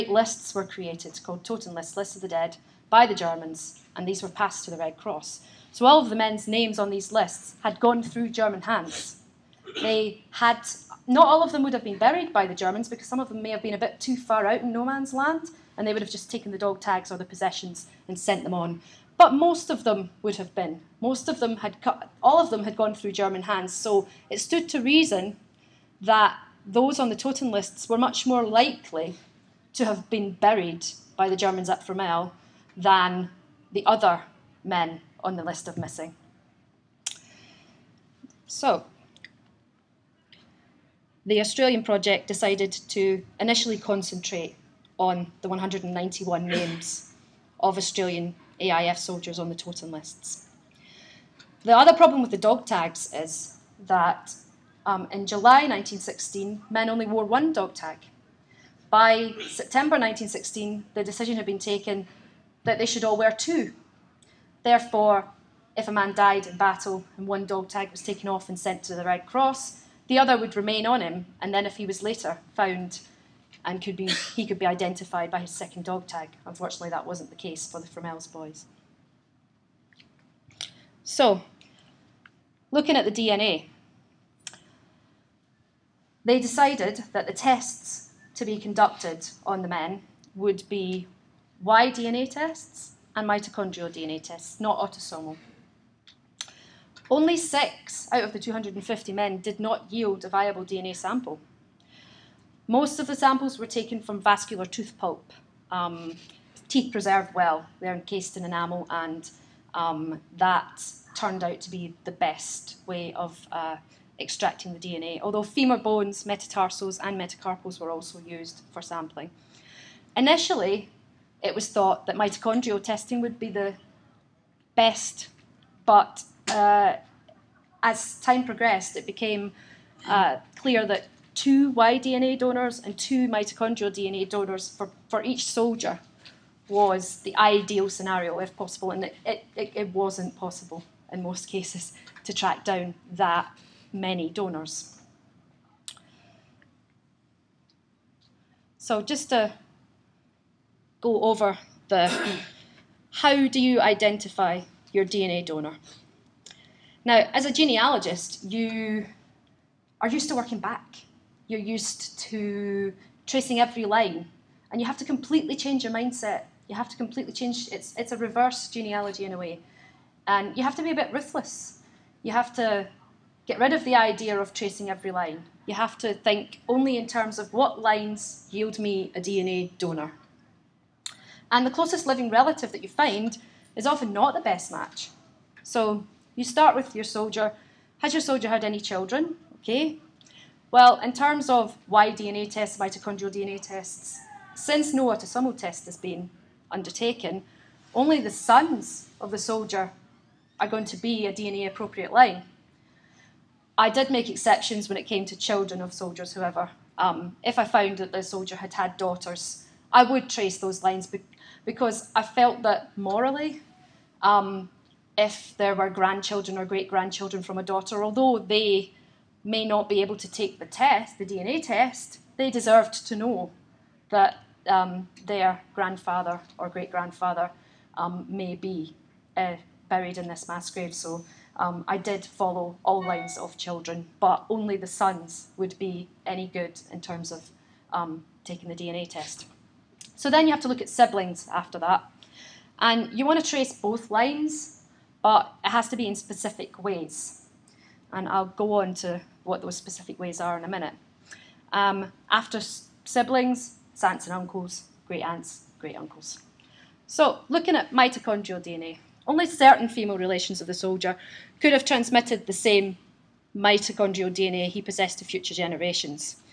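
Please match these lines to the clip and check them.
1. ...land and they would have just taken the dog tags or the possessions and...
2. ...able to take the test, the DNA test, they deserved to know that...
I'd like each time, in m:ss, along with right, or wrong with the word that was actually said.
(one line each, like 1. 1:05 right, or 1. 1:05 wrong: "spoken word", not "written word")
1. 0:15 right
2. 3:40 right.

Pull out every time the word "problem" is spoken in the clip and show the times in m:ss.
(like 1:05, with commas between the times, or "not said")
0:51.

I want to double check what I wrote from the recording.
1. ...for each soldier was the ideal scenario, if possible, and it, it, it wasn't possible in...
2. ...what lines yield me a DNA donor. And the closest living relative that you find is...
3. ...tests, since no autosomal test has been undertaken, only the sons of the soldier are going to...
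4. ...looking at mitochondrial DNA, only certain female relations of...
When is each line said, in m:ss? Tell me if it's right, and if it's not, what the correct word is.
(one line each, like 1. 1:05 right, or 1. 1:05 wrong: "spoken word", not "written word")
1. 2:15 right
2. 2:57 right
3. 3:13 right
4. 4:17 right.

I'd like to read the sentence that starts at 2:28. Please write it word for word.
So just to go over the how do you identify your DNA donor?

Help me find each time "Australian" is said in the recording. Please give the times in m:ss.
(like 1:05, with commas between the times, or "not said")
0:41, 0:47.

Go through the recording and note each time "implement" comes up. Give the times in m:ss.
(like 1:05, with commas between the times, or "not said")
not said.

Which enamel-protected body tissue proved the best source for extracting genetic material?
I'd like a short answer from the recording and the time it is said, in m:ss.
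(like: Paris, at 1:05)
Vascular tooth pulp, at 1:44.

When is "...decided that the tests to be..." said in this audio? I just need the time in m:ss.
1:26.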